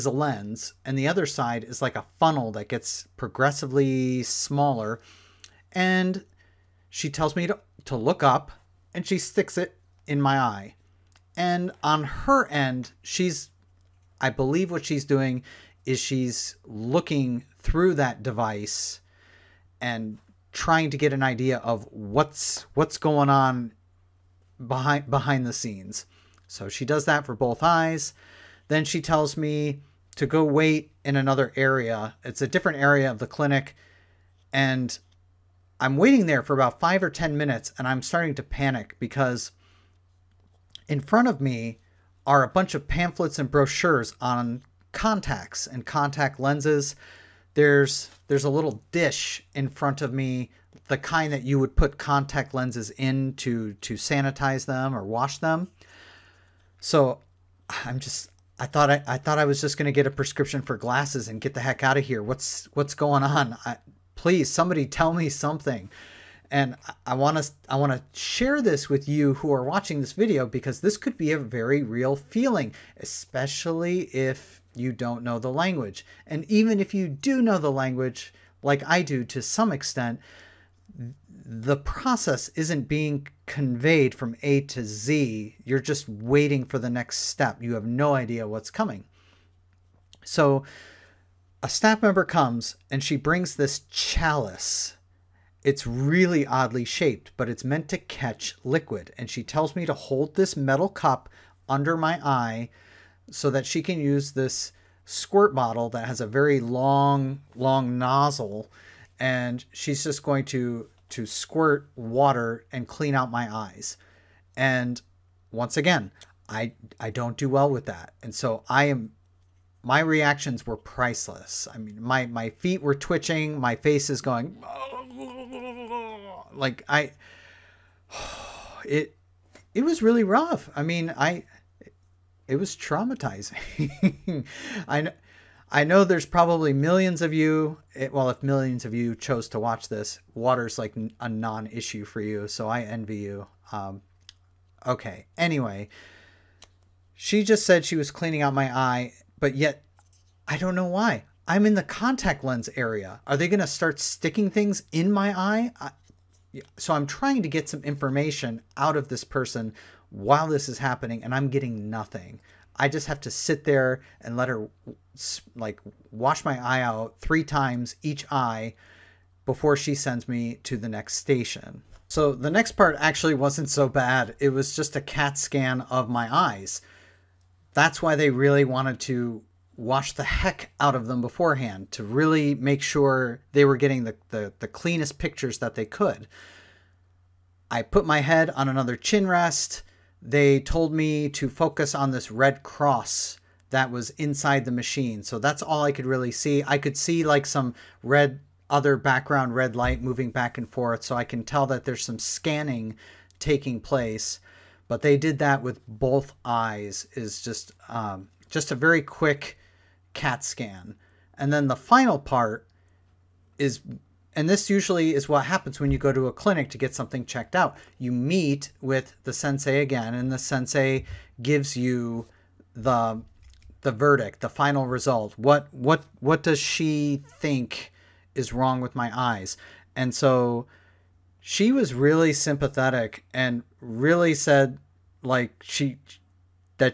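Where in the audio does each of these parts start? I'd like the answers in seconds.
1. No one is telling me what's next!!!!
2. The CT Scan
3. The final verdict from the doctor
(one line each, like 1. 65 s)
1. 26 s
2. 171 s
3. 210 s.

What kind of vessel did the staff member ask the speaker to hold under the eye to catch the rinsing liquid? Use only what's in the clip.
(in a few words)
metal cup.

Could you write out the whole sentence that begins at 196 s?
I could see like some red, other background red light moving back and forth.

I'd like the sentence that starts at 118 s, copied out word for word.
And so I am my reactions were priceless.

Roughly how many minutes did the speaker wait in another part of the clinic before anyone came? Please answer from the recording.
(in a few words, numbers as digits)
5 or 10.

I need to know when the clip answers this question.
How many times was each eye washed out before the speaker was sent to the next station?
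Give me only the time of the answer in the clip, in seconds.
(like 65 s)
167 s.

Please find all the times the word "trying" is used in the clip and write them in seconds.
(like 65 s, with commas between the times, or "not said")
20 s, 157 s.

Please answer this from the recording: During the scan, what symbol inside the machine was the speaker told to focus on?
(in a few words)
red cross.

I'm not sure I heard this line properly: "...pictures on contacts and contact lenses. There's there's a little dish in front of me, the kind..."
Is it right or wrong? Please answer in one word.
wrong.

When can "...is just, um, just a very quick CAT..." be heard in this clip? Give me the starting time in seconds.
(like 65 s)
207 s.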